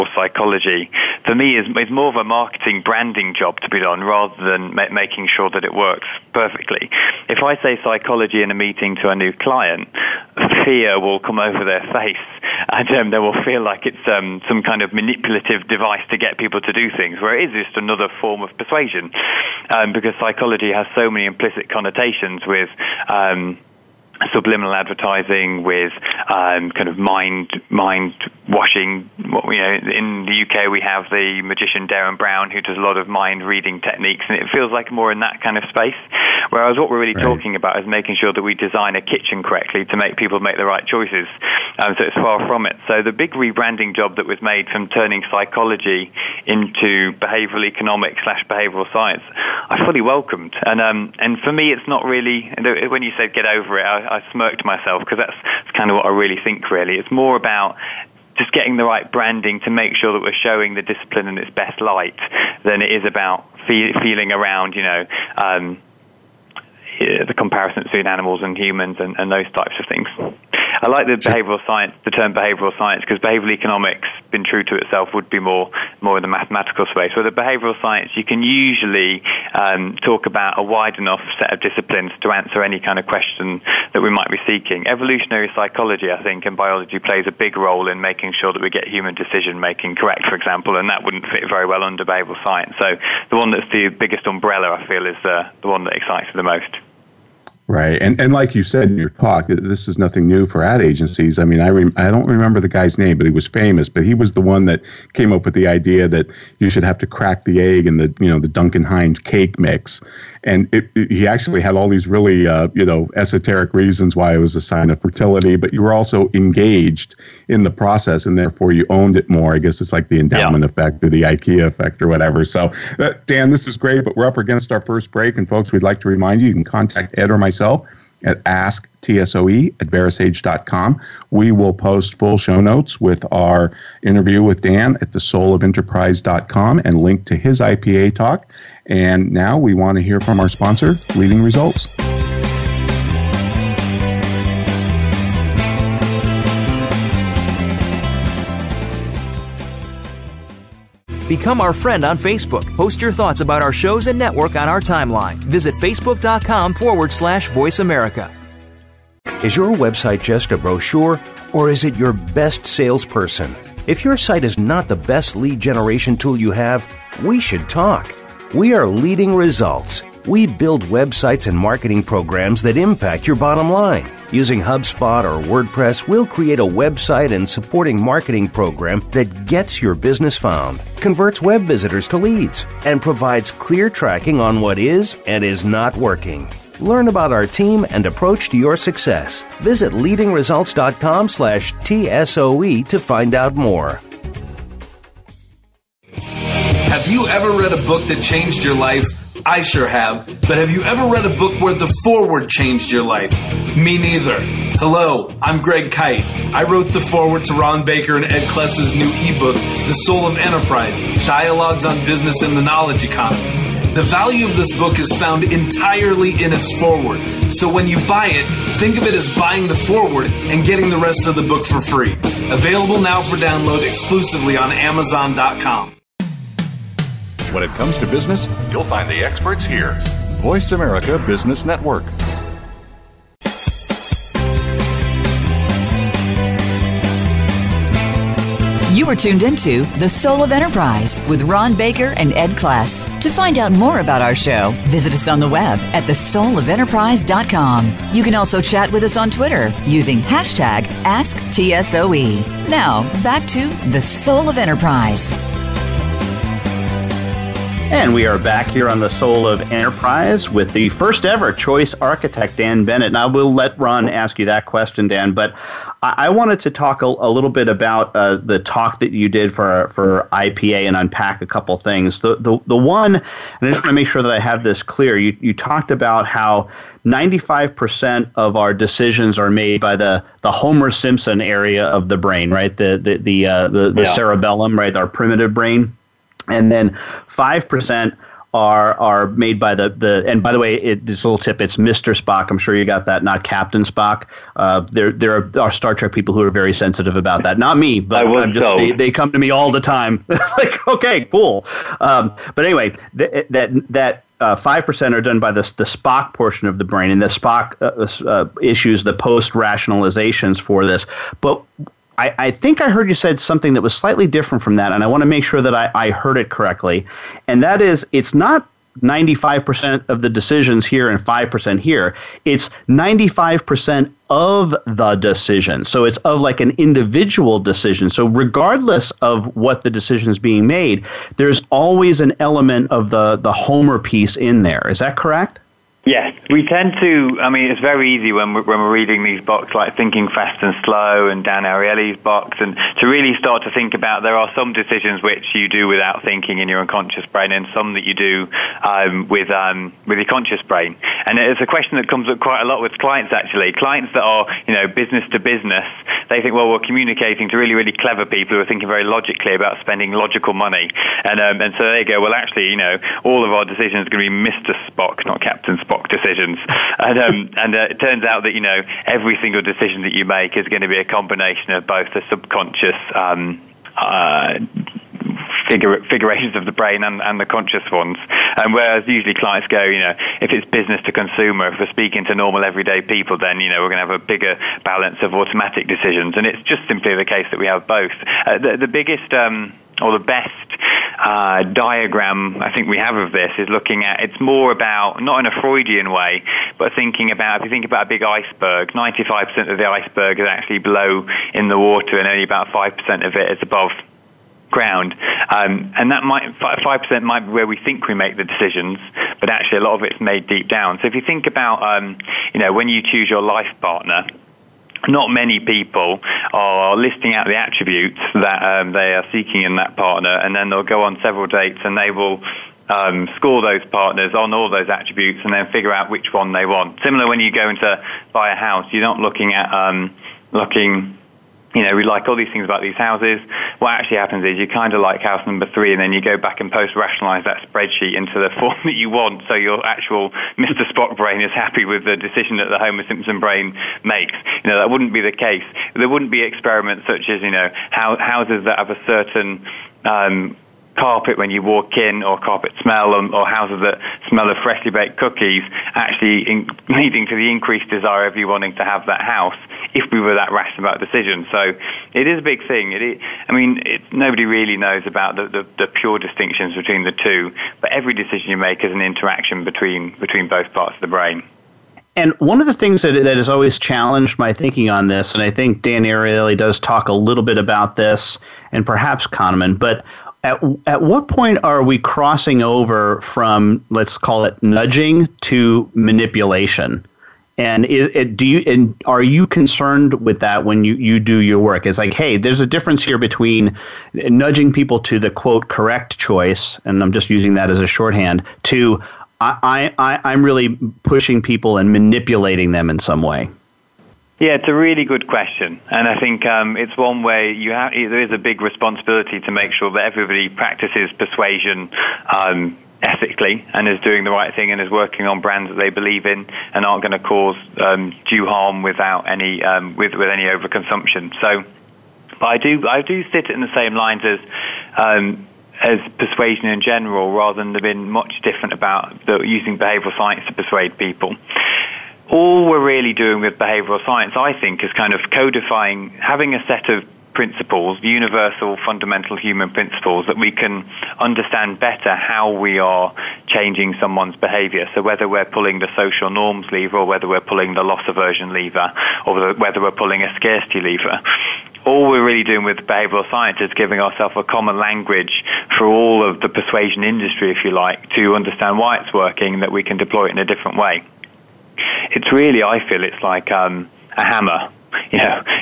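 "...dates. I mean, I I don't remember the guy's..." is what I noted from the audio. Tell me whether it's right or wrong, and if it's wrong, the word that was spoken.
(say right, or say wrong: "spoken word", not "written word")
wrong: "agencies", not "dates".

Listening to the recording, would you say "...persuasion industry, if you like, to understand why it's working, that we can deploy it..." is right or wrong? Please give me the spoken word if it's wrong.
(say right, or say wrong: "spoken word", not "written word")
right.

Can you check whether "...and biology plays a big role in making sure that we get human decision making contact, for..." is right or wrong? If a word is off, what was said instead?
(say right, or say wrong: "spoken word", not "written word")
wrong: "correct", not "contact".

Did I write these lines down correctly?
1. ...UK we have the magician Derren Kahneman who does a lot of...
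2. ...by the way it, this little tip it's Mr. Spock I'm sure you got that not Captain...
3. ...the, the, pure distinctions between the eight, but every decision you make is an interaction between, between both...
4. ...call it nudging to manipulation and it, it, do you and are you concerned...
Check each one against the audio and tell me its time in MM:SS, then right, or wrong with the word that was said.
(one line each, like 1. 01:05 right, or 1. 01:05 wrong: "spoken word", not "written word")
1. 00:30 wrong: "Brown", not "Kahneman"
2. 04:50 right
3. 07:45 wrong: "two", not "eight"
4. 08:04 right.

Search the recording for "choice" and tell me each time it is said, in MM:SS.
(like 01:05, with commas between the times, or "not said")
00:40, 04:21, 08:16.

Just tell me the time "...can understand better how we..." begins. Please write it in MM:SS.
09:00.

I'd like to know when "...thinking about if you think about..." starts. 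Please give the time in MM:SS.
06:36.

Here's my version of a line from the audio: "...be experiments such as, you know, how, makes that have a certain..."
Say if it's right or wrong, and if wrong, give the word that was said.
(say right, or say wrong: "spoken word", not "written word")
wrong: "houses", not "makes".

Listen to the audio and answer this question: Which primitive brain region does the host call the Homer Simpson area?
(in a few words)
cerebellum.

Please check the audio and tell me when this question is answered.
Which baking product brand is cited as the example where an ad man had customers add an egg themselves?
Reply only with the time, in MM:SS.
01:48.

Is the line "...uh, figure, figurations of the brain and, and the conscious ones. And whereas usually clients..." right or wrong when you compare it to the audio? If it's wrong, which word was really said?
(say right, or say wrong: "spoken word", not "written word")
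right.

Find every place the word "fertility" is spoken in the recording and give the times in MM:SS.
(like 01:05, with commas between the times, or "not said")
01:55.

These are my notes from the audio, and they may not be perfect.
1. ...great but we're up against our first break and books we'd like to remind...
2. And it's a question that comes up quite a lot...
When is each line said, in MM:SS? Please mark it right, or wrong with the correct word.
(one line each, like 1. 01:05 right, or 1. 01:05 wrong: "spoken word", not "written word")
1. 02:03 wrong: "folks", not "books"
2. 05:51 right.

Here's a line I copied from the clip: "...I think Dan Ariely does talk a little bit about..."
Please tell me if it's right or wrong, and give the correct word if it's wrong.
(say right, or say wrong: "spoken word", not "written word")
right.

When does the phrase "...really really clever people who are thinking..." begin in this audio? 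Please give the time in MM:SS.
05:57.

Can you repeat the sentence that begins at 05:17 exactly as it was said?
And that is, it's not 95% of the decisions here and 5% here.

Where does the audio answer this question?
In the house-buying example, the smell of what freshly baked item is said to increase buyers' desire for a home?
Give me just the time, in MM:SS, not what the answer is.
07:35.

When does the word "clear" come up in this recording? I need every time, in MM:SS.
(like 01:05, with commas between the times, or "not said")
03:03, 04:34.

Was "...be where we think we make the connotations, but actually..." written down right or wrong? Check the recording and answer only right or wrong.
wrong.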